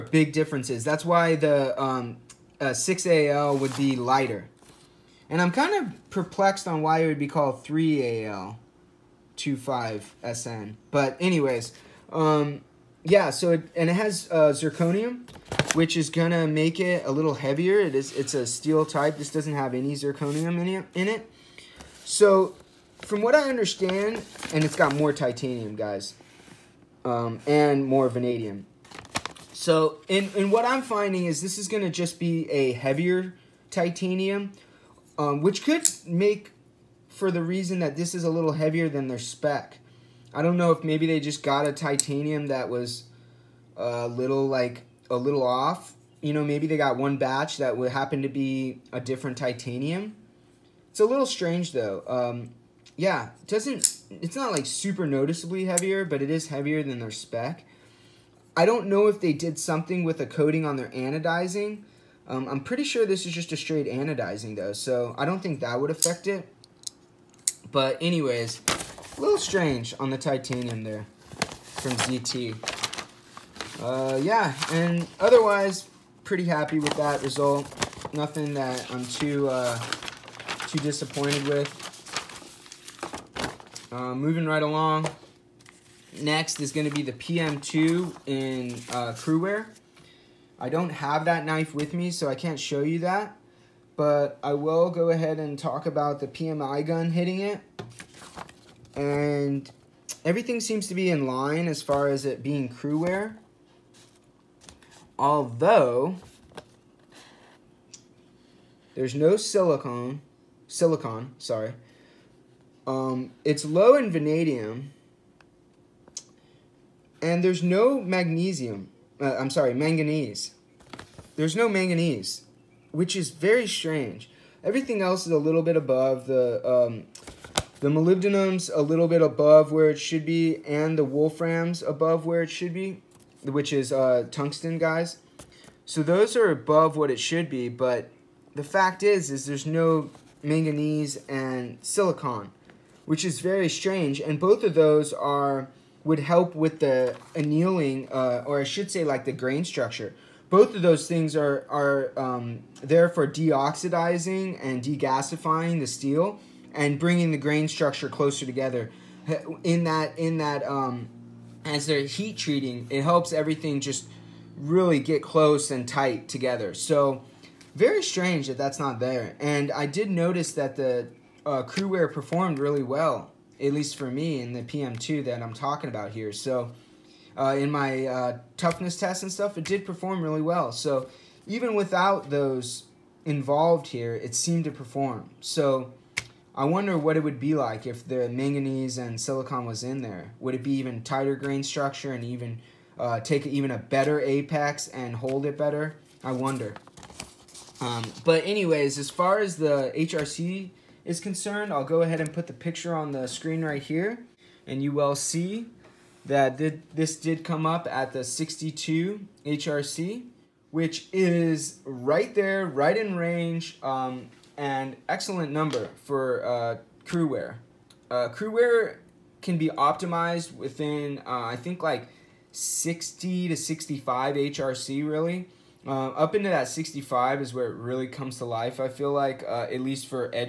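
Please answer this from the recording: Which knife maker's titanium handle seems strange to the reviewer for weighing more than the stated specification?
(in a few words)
ZT.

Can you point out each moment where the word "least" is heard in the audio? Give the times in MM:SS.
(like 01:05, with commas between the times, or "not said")
02:53, 03:49.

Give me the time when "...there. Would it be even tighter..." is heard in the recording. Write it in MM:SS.
03:10.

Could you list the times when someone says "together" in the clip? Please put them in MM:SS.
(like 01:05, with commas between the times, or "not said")
02:38, 02:46.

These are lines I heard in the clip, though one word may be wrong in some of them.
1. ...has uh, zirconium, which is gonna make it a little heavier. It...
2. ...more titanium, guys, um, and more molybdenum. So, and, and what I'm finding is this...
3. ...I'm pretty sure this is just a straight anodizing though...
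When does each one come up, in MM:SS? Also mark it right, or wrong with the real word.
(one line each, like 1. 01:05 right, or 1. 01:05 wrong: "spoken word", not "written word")
1. 00:13 right
2. 00:24 wrong: "vanadium", not "molybdenum"
3. 01:02 right.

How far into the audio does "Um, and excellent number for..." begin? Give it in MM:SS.
03:33.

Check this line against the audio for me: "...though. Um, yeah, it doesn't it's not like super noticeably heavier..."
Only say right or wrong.
right.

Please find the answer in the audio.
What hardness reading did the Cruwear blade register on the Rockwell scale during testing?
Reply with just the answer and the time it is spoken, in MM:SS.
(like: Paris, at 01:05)
62 HRC, at 03:28.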